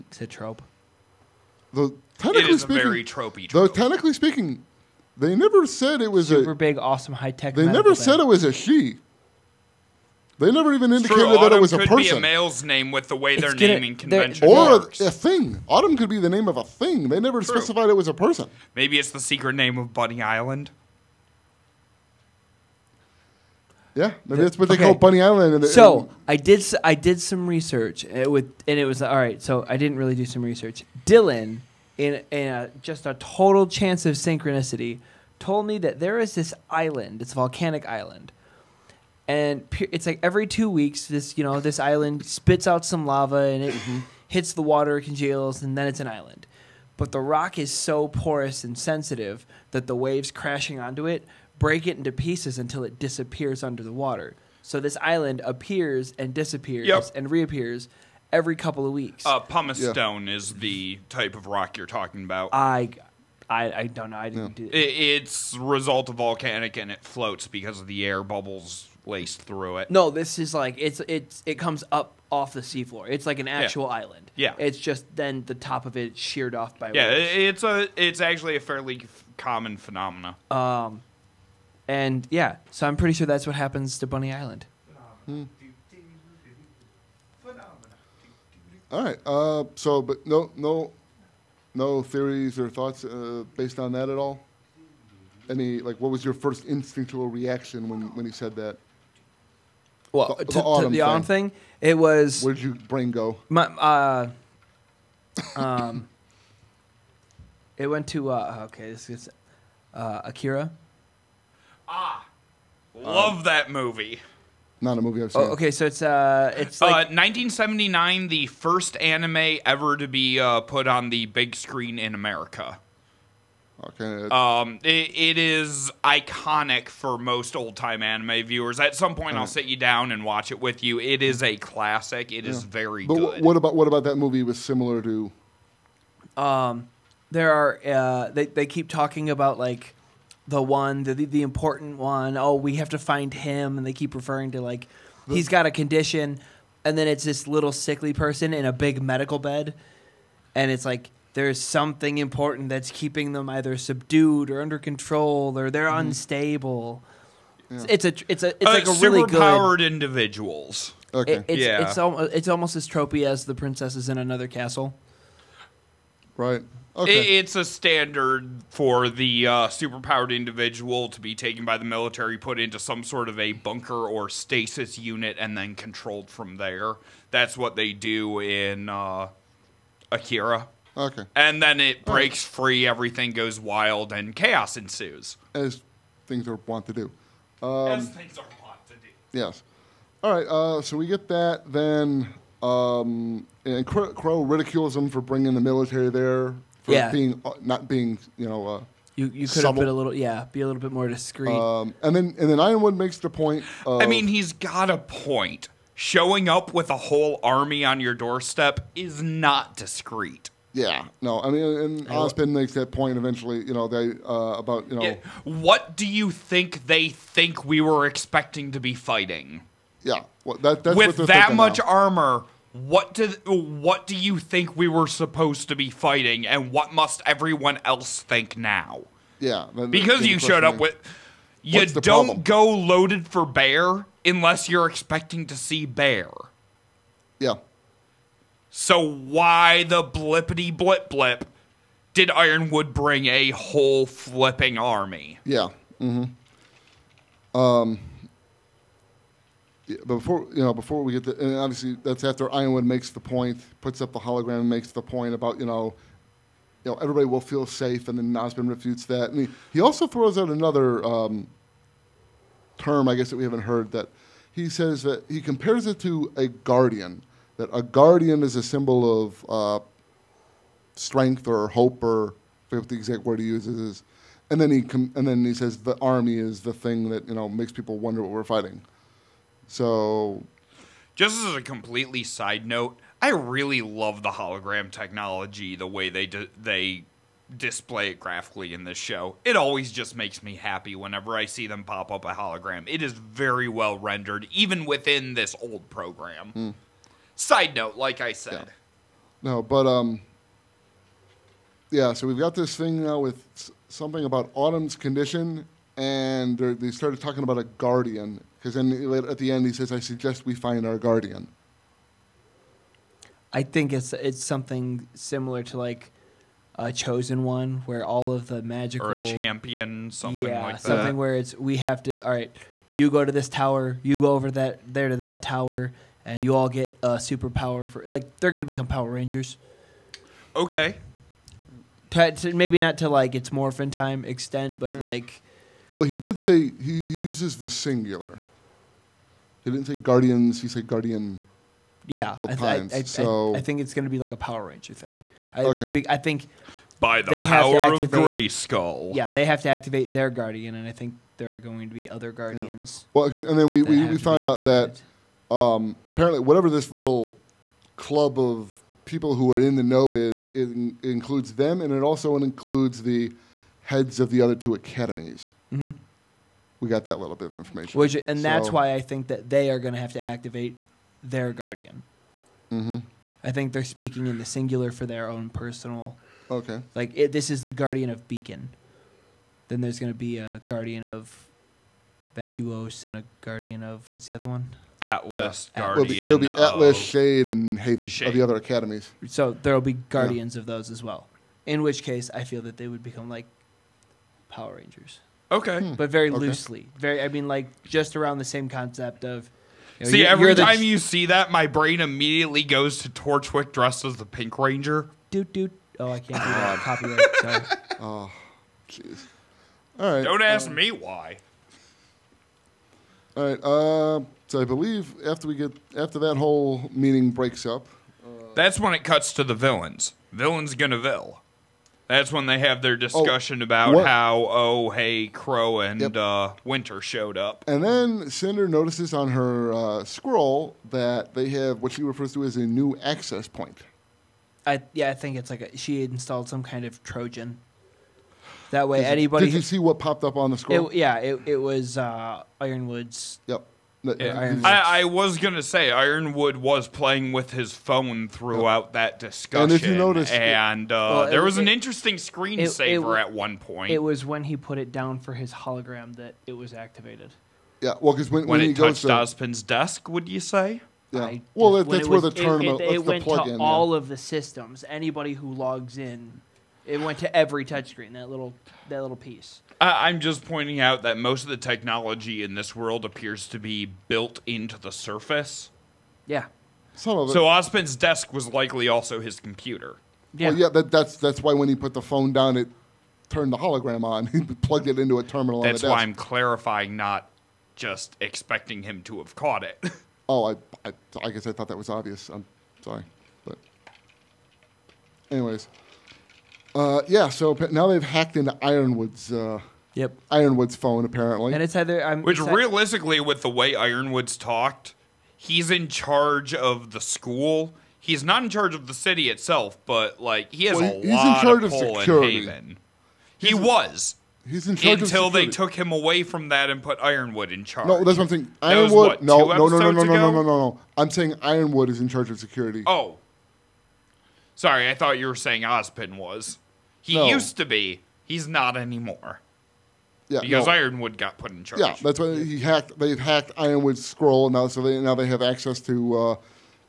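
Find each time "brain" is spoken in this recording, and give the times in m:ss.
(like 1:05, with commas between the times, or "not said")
1:42, 6:41.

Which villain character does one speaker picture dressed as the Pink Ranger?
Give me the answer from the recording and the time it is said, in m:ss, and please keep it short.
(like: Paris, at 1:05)
Torchwick, at 6:43.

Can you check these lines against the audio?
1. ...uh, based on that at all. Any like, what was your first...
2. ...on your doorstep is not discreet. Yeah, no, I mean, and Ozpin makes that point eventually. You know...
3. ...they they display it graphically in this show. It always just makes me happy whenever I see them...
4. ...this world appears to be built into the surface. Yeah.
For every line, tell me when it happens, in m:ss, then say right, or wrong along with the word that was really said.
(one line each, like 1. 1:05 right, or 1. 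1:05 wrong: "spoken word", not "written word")
1. 1:33 right
2. 3:27 right
3. 4:46 right
4. 7:52 right.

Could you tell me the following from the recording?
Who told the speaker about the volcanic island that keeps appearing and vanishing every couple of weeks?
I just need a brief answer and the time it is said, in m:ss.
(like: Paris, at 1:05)
Dylan, at 0:31.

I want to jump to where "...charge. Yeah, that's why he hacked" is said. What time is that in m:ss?
8:51.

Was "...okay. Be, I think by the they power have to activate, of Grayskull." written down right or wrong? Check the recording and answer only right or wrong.
right.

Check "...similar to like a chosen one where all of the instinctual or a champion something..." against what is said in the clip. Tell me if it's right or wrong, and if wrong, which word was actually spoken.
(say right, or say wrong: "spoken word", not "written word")
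wrong: "magical", not "instinctual".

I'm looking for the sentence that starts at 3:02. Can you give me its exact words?
free, everything goes wild, and chaos ensues.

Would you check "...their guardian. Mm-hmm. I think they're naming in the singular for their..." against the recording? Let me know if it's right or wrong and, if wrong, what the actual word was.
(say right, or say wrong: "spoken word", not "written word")
wrong: "speaking", not "naming".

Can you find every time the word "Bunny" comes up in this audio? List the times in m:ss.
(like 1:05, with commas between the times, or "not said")
0:19, 0:24, 1:24.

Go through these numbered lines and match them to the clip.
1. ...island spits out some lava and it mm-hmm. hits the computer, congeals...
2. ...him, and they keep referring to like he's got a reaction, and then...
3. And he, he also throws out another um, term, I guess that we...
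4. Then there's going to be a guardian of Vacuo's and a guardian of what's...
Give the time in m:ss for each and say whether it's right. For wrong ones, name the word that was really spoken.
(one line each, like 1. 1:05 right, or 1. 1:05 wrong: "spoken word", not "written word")
1. 0:41 wrong: "water", not "computer"
2. 2:23 wrong: "condition", not "reaction"
3. 4:19 right
4. 6:19 right.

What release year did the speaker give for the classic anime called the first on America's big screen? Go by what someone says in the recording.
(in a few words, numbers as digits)
1979.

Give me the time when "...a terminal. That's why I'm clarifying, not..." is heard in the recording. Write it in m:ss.
8:05.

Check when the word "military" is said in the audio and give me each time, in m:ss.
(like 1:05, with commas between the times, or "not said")
2:51, 3:15.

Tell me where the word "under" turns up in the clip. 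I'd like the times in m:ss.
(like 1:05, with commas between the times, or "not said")
0:53, 2:34.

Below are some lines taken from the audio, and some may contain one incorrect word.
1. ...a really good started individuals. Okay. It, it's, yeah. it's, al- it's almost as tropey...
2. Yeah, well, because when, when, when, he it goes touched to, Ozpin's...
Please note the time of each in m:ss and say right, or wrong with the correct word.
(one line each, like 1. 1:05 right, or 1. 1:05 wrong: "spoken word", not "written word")
1. 2:38 wrong: "powered", not "started"
2. 7:37 right.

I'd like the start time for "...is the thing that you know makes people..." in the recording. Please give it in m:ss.
4:36.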